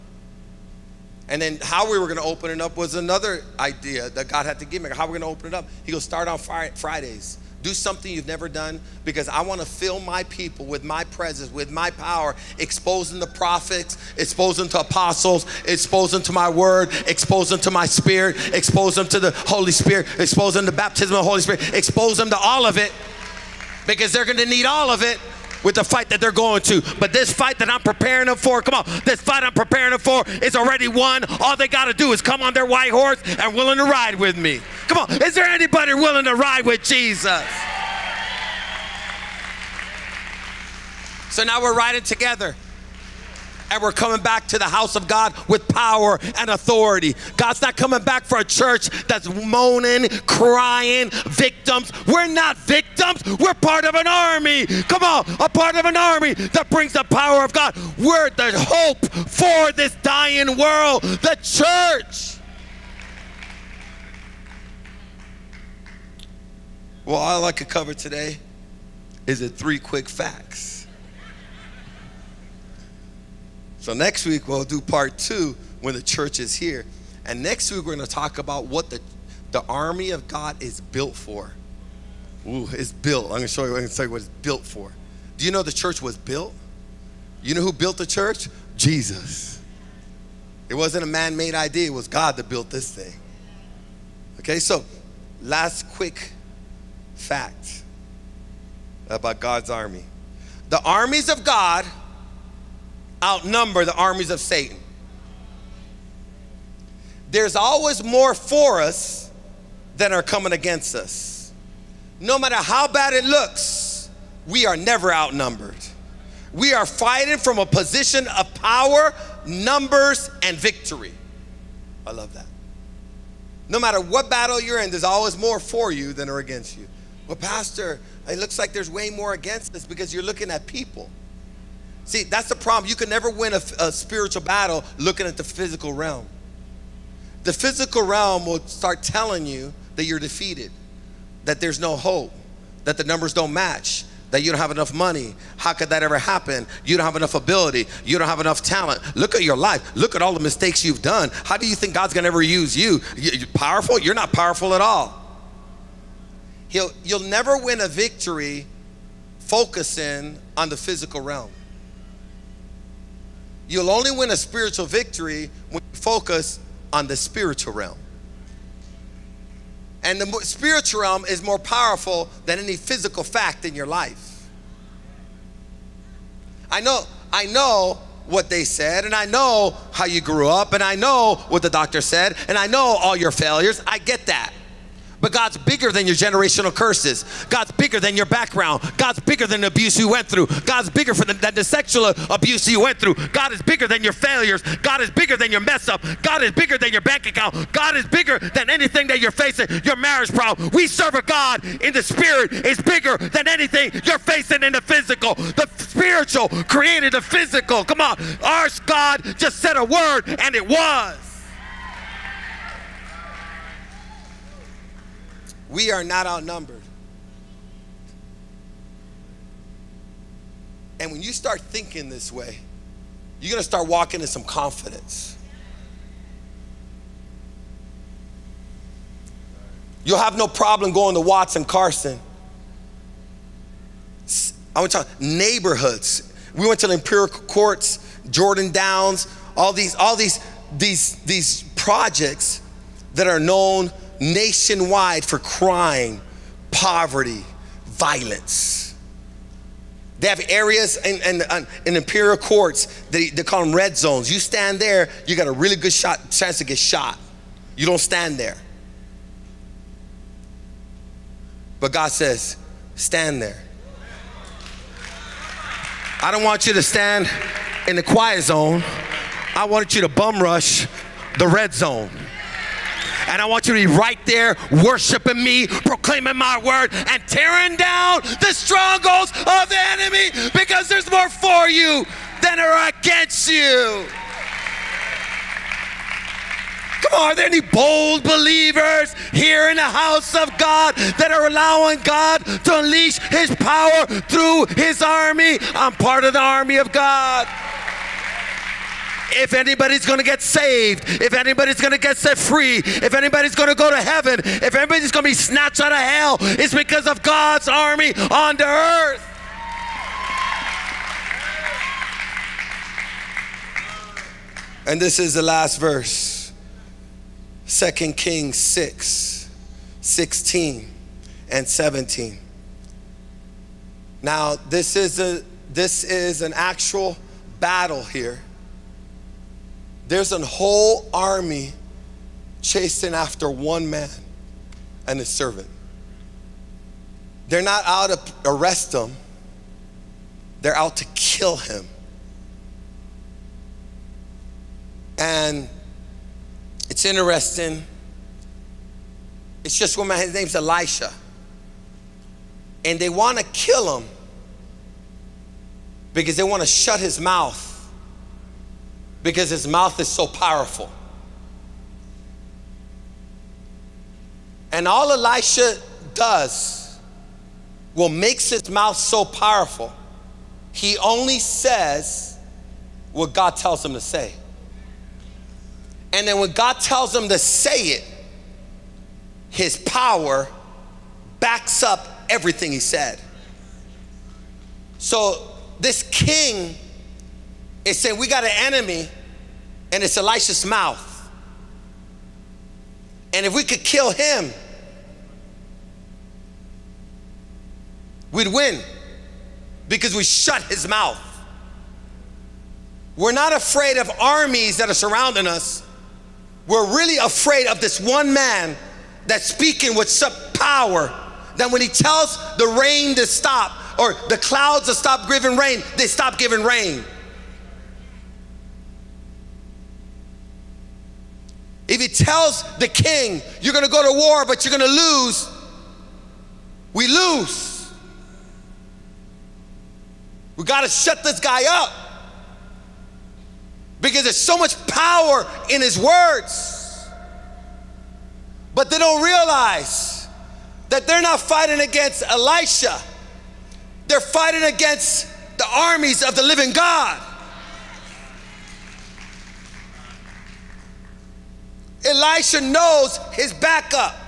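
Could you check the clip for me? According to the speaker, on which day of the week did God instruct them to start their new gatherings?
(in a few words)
Fridays.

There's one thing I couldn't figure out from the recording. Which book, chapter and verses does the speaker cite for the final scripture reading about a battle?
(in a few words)
2 Kings 6:16-17.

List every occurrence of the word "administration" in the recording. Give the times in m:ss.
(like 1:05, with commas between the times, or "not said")
not said.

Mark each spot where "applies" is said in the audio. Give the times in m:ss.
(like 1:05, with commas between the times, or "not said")
not said.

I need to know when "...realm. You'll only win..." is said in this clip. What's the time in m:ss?
2:41.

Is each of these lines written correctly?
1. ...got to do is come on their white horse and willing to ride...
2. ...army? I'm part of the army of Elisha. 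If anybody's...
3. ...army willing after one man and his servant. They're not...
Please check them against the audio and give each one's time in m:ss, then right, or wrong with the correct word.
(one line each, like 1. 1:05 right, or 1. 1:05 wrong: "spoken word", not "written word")
1. 0:31 right
2. 4:55 wrong: "God", not "Elisha"
3. 5:31 wrong: "chasing", not "willing".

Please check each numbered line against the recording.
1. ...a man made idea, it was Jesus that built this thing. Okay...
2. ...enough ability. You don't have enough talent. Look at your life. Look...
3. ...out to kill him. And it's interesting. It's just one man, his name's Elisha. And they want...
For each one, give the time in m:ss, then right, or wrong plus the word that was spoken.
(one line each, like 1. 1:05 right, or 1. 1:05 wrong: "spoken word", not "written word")
1. 1:31 wrong: "God", not "Jesus"
2. 2:27 right
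3. 5:40 right.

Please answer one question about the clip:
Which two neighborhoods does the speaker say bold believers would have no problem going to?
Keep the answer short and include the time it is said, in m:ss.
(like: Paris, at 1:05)
Watts and Carson, at 3:51.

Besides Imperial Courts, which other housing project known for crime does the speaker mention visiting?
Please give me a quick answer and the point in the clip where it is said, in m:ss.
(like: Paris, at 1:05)
Jordan Downs, at 3:58.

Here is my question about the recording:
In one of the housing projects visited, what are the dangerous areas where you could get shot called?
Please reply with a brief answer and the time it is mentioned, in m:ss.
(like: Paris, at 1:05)
Red zones, at 4:13.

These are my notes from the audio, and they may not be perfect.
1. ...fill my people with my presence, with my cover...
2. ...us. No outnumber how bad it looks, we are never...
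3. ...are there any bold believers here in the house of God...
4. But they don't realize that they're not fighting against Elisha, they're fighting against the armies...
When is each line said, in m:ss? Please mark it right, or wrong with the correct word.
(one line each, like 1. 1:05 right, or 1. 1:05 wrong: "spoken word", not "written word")
1. 0:09 wrong: "power", not "cover"
2. 1:50 wrong: "matter", not "outnumber"
3. 4:47 right
4. 7:18 right.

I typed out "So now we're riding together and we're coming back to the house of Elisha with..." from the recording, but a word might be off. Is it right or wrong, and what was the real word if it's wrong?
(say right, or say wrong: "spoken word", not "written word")
wrong: "God", not "Elisha".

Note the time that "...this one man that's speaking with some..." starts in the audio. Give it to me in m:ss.
6:47.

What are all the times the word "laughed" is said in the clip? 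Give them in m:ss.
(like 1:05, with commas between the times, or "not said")
not said.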